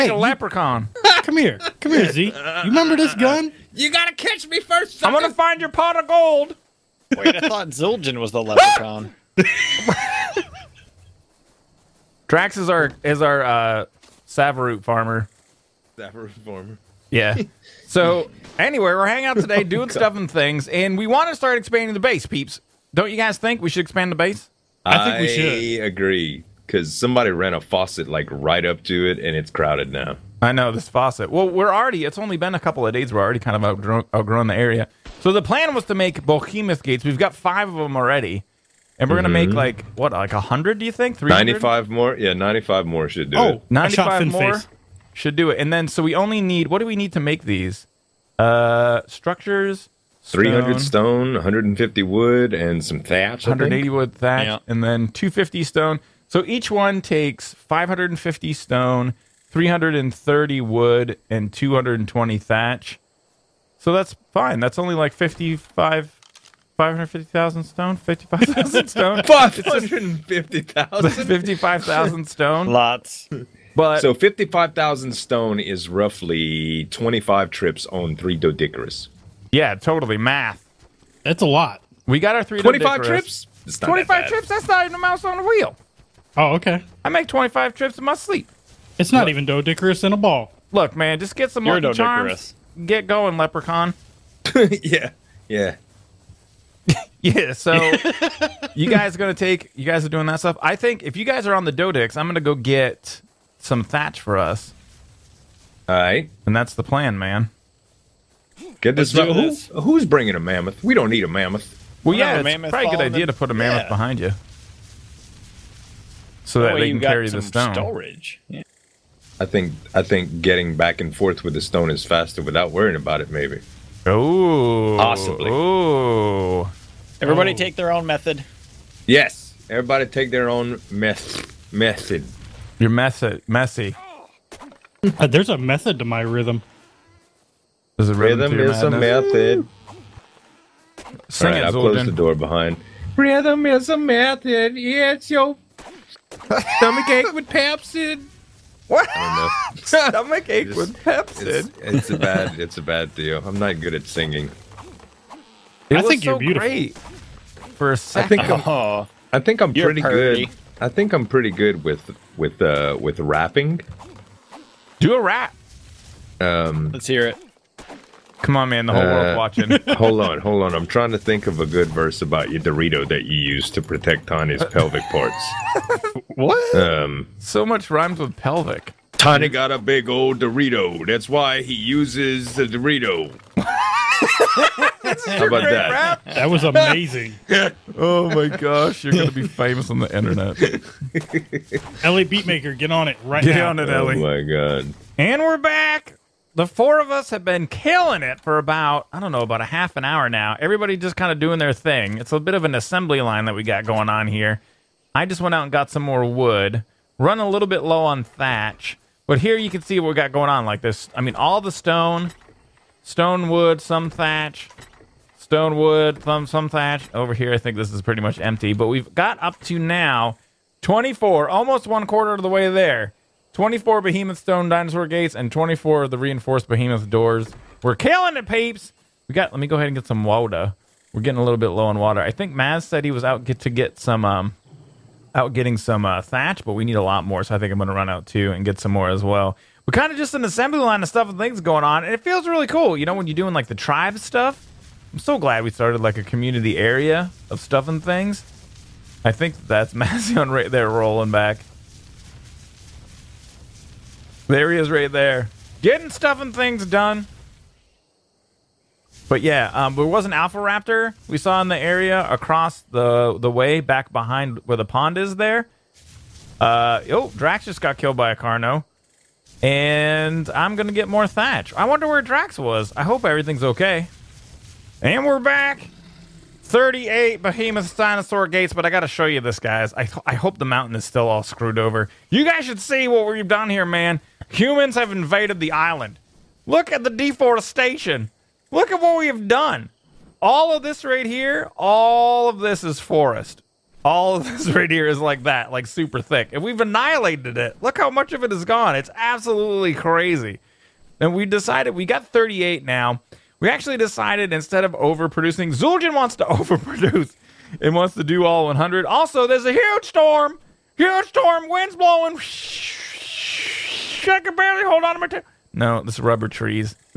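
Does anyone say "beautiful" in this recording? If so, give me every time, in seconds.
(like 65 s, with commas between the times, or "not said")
156 s.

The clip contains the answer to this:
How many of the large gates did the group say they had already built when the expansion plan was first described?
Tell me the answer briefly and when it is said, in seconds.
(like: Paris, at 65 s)
5, at 37 s.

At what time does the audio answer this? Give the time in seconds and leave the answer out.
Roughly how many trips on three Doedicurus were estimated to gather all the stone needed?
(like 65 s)
75 s.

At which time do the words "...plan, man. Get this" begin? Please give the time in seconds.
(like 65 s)
106 s.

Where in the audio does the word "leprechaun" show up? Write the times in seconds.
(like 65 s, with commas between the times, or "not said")
0 s, 8 s, 93 s.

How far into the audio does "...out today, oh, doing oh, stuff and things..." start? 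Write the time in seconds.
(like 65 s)
19 s.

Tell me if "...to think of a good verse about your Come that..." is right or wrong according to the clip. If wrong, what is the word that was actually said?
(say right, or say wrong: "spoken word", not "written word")
wrong: "Dorito", not "Come".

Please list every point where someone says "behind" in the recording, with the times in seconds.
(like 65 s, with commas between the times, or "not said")
113 s, 142 s, 264 s.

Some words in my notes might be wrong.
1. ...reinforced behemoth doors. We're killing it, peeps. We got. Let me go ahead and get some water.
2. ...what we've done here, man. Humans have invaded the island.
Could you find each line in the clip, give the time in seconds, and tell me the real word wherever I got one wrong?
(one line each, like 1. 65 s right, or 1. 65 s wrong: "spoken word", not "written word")
1. 226 s right
2. 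283 s right.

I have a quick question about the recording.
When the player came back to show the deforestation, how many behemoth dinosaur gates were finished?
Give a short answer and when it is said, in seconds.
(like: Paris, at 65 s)
38, at 276 s.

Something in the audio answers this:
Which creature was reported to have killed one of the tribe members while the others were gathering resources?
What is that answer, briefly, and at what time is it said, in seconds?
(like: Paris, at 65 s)
Carno, at 267 s.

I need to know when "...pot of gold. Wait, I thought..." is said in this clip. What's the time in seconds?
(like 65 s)
5 s.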